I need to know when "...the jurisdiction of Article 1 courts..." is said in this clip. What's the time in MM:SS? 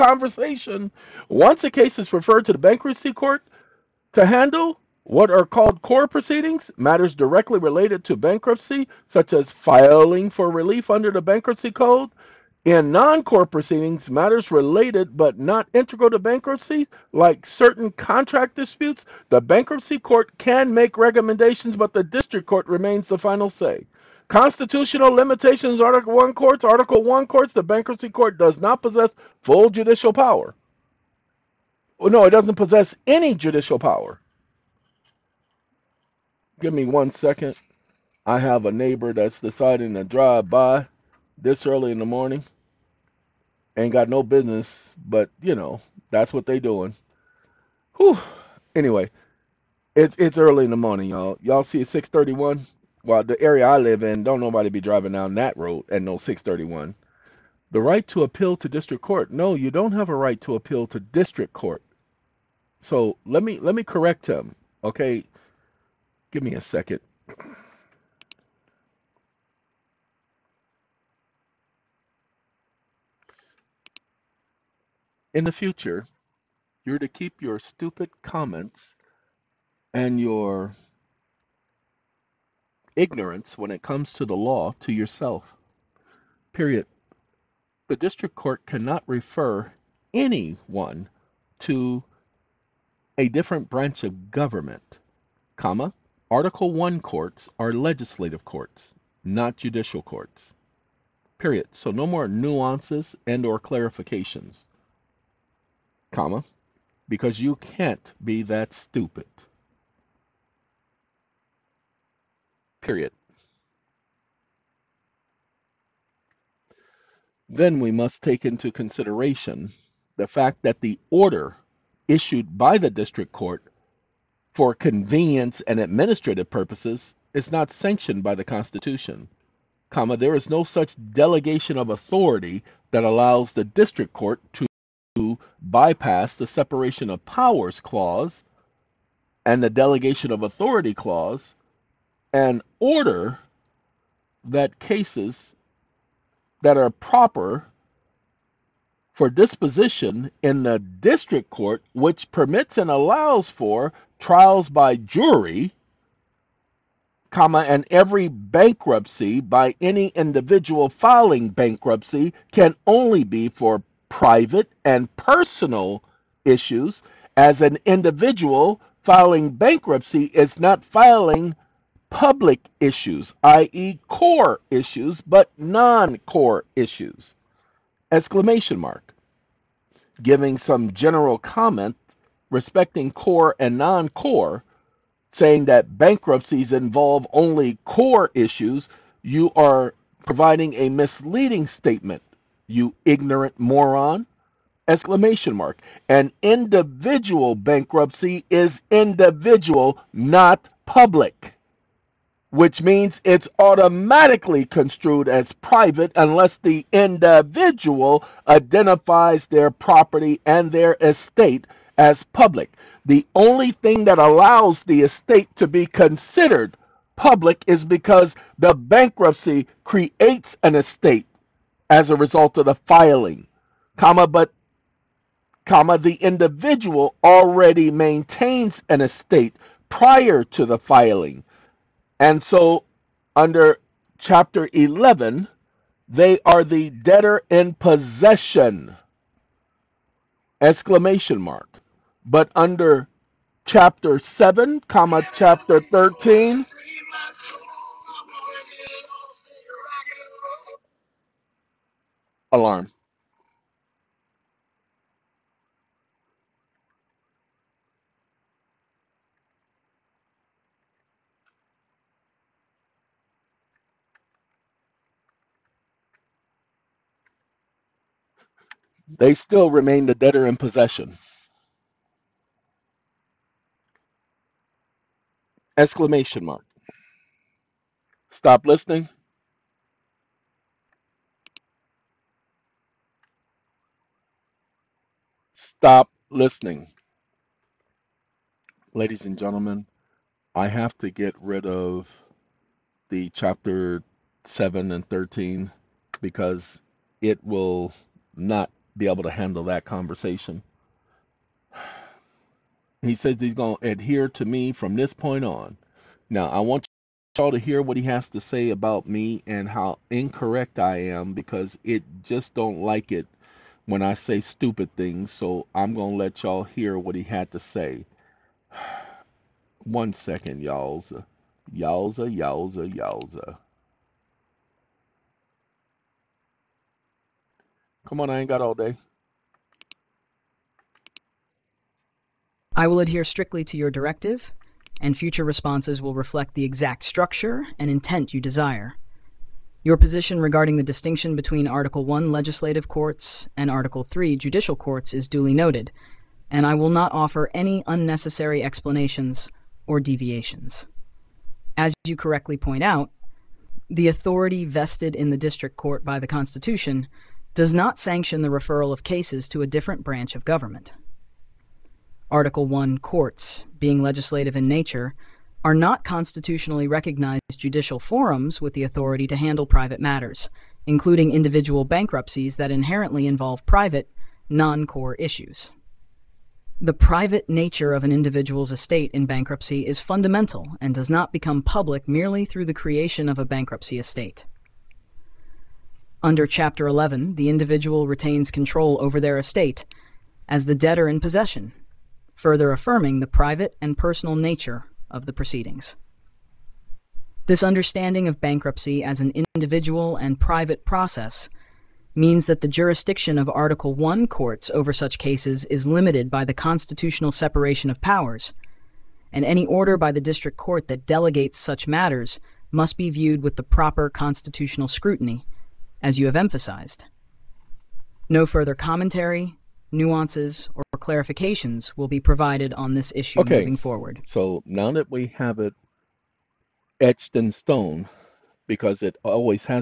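06:42.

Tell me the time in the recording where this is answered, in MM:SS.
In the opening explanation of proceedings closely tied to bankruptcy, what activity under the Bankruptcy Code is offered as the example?
00:09.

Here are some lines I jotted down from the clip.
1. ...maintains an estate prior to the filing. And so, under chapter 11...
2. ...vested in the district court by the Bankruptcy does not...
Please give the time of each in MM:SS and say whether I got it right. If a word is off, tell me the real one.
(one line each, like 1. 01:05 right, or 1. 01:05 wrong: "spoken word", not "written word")
1. 03:47 right
2. 05:54 wrong: "Constitution", not "Bankruptcy".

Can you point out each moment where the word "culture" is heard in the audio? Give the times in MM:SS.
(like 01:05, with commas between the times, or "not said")
not said.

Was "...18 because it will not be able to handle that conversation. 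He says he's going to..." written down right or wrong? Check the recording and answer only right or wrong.
wrong.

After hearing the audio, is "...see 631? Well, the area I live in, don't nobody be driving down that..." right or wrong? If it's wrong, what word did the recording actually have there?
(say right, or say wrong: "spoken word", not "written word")
right.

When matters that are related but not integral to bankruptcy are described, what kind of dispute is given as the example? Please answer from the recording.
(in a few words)
Certain contract disputes.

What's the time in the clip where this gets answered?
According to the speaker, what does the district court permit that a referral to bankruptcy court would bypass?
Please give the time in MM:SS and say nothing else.
02:34.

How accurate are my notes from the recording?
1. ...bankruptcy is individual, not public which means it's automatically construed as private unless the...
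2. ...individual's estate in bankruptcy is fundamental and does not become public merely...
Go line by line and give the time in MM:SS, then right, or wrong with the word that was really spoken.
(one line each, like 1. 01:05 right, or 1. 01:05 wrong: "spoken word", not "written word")
1. 03:17 right
2. 06:18 right.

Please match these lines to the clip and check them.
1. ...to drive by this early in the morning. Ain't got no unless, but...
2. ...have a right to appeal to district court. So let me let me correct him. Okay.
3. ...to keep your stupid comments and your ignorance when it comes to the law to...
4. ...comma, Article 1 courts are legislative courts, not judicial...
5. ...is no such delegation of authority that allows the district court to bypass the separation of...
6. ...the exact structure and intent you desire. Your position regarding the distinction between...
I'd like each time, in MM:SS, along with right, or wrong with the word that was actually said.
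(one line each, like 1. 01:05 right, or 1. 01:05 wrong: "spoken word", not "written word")
1. 00:39 wrong: "business", not "unless"
2. 00:59 right
3. 01:16 right
4. 01:35 right
5. 02:10 right
6. 05:36 right.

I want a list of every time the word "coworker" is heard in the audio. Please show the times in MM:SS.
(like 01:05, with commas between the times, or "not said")
not said.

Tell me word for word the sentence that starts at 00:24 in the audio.
Constitutional limitations, Article 1 courts, Article 1 courts, the bankruptcy court does not possess full judicial power.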